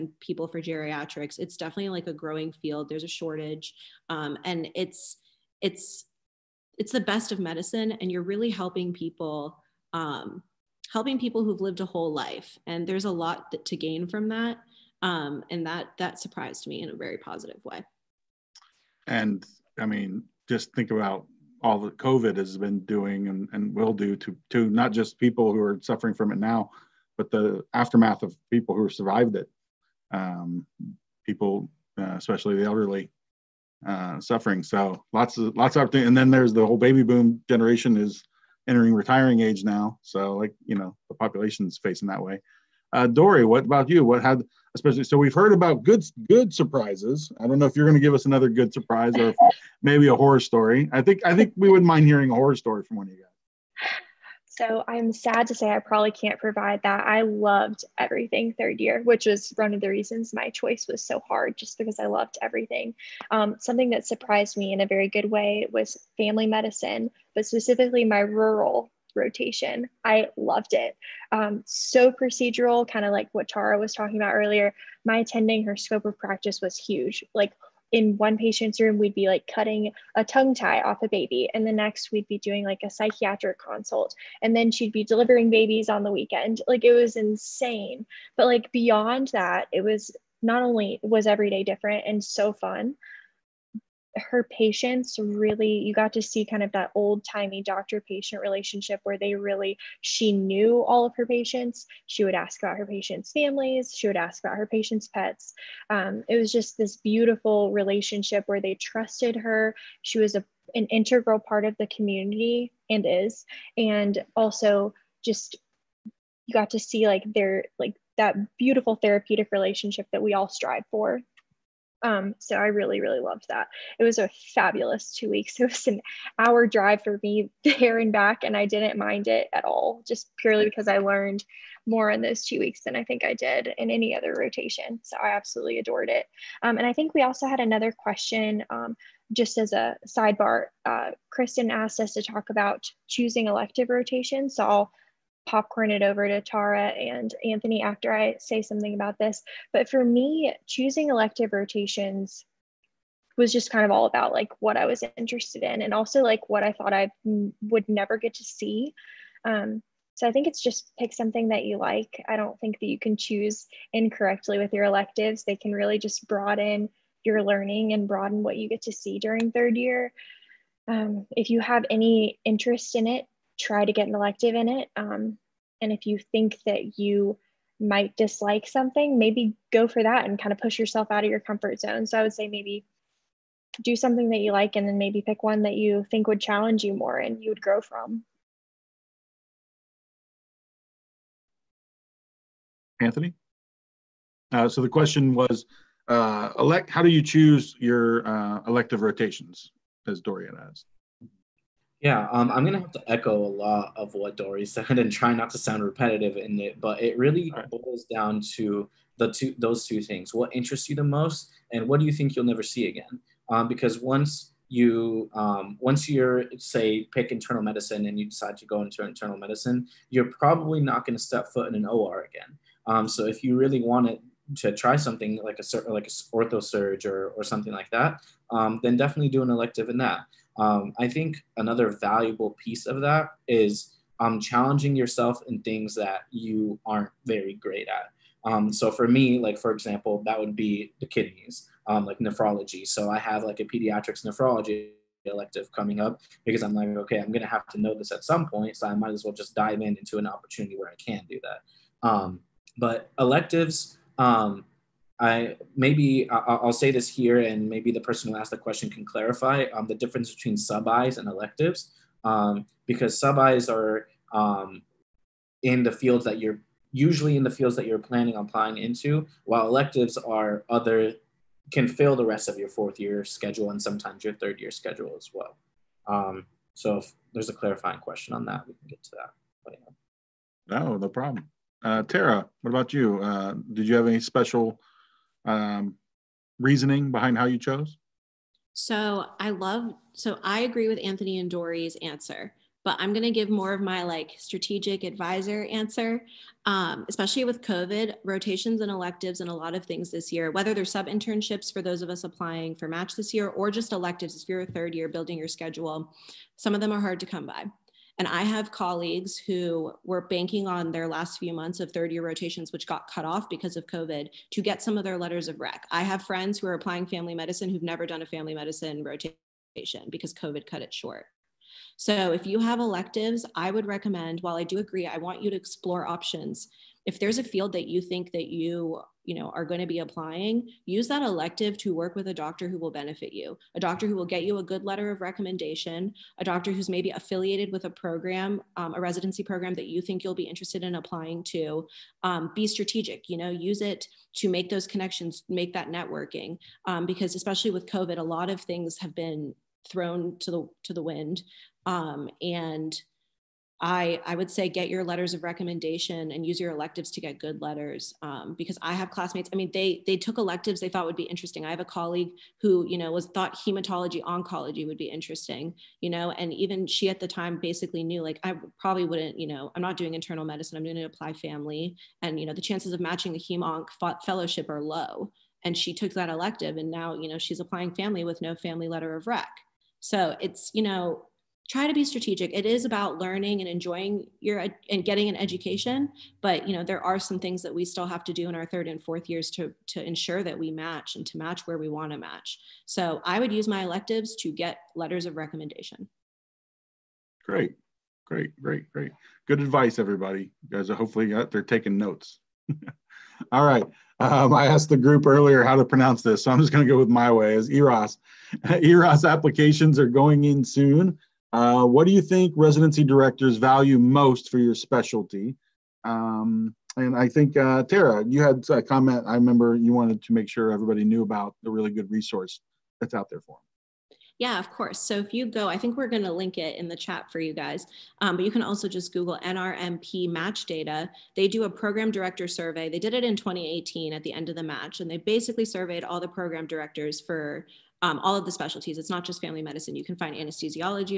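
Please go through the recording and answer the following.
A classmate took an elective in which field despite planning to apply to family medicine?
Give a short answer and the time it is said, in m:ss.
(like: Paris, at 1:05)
Hematology oncology, at 6:03.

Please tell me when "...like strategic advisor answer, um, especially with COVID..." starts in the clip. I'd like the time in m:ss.
4:54.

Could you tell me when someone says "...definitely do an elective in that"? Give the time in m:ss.
3:48.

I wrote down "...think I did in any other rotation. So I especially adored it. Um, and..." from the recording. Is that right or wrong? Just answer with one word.
wrong.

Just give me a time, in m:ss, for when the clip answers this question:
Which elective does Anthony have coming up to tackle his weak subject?
4:03.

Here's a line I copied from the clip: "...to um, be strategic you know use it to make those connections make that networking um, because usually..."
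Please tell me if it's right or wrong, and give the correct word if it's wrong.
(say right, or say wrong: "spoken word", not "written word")
wrong: "especially", not "usually".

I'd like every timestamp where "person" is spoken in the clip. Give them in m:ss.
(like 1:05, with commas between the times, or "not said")
4:18.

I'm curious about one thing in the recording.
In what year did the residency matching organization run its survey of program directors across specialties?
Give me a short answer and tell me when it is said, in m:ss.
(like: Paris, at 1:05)
2018, at 7:13.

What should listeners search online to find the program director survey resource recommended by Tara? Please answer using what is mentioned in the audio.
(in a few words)
NRMP match data.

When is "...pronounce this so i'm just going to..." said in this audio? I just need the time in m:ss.
6:45.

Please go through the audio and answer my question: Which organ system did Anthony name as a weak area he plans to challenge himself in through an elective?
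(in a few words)
Kidneys.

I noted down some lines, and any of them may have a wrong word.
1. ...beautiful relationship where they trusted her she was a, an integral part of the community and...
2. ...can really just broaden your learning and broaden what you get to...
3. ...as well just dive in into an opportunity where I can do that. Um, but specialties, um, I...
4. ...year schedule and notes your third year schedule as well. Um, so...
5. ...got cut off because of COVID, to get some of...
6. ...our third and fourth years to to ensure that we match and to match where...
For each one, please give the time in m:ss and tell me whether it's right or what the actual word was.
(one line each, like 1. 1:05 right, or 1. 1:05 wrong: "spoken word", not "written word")
1. 1:46 right
2. 2:45 right
3. 4:09 wrong: "electives", not "specialties"
4. 4:33 wrong: "sometimes", not "notes"
5. 5:12 right
6. 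6:28 right.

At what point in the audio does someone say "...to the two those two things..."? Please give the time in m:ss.
3:28.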